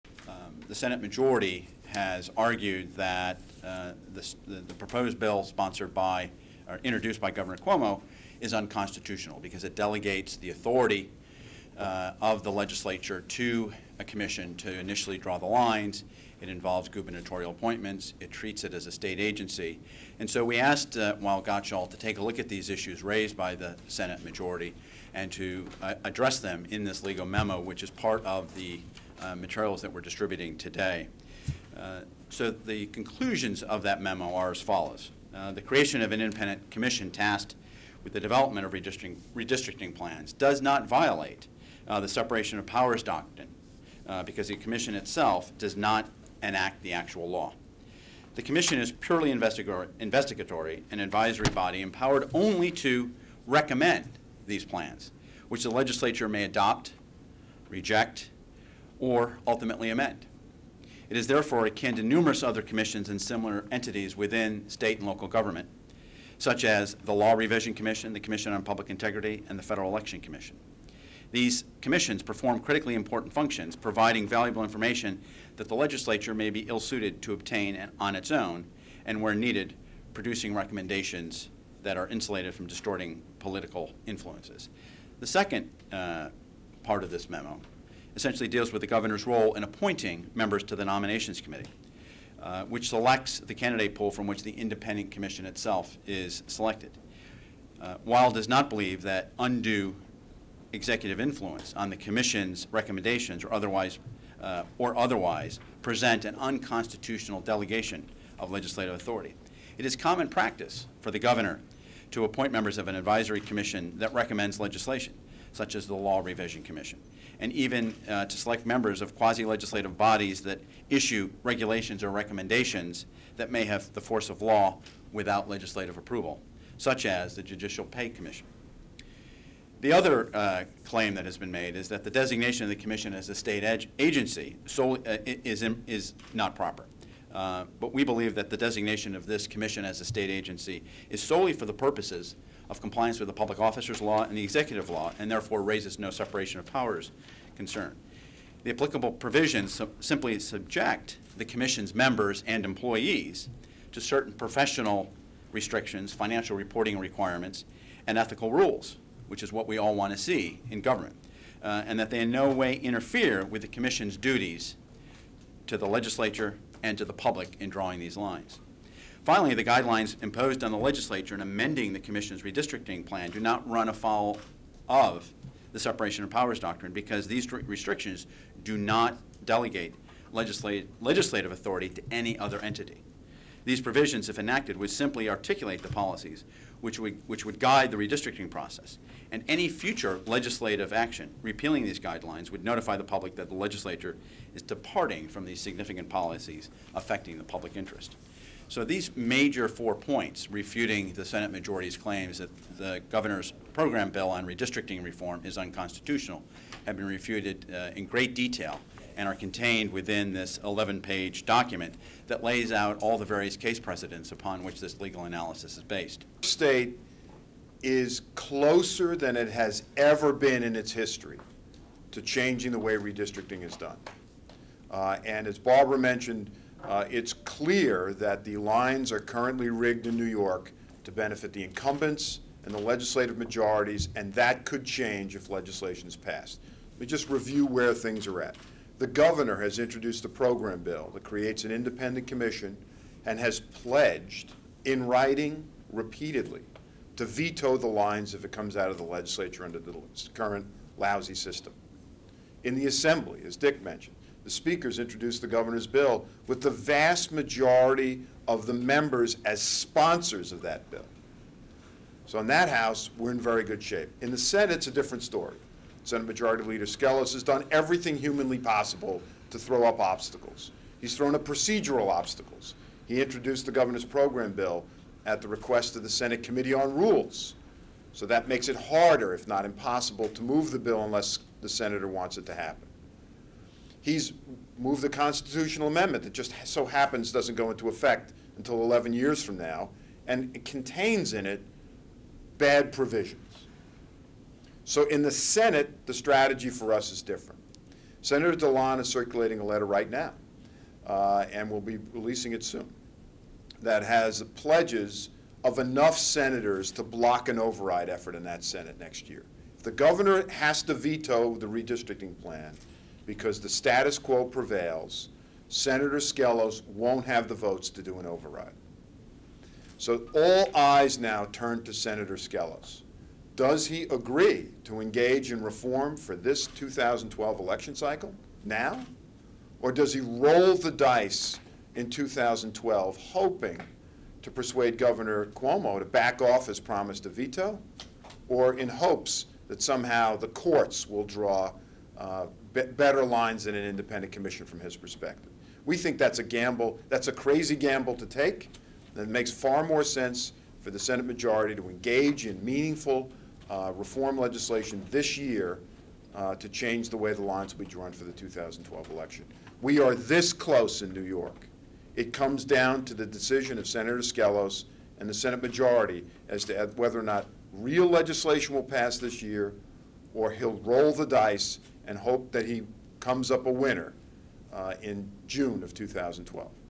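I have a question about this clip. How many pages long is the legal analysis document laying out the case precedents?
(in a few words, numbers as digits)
11.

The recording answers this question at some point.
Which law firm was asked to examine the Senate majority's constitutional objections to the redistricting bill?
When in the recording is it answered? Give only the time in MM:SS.
00:21.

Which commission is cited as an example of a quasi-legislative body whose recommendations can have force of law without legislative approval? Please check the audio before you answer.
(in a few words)
Judicial Pay Commission.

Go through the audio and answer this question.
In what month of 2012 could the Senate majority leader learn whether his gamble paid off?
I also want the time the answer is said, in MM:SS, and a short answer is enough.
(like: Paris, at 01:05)
June, at 06:15.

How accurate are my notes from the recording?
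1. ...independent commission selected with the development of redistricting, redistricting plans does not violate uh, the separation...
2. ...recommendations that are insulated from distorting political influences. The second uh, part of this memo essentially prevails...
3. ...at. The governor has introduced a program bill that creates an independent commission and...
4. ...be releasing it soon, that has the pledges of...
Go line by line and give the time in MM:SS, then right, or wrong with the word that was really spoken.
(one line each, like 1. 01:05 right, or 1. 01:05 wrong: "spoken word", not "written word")
1. 00:36 wrong: "tasked", not "selected"
2. 01:20 wrong: "deals", not "prevails"
3. 03:58 right
4. 05:01 right.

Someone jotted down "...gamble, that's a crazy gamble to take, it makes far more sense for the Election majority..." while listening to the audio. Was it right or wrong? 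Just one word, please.
wrong.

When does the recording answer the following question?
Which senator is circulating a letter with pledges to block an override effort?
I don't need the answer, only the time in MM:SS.
04:58.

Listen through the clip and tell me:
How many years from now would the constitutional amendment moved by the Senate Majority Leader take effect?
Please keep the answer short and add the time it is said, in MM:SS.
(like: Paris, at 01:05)
11, at 04:48.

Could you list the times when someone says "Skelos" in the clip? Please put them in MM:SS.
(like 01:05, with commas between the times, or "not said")
04:26, 05:16, 05:22, 06:04.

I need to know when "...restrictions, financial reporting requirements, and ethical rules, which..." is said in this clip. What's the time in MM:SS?
02:35.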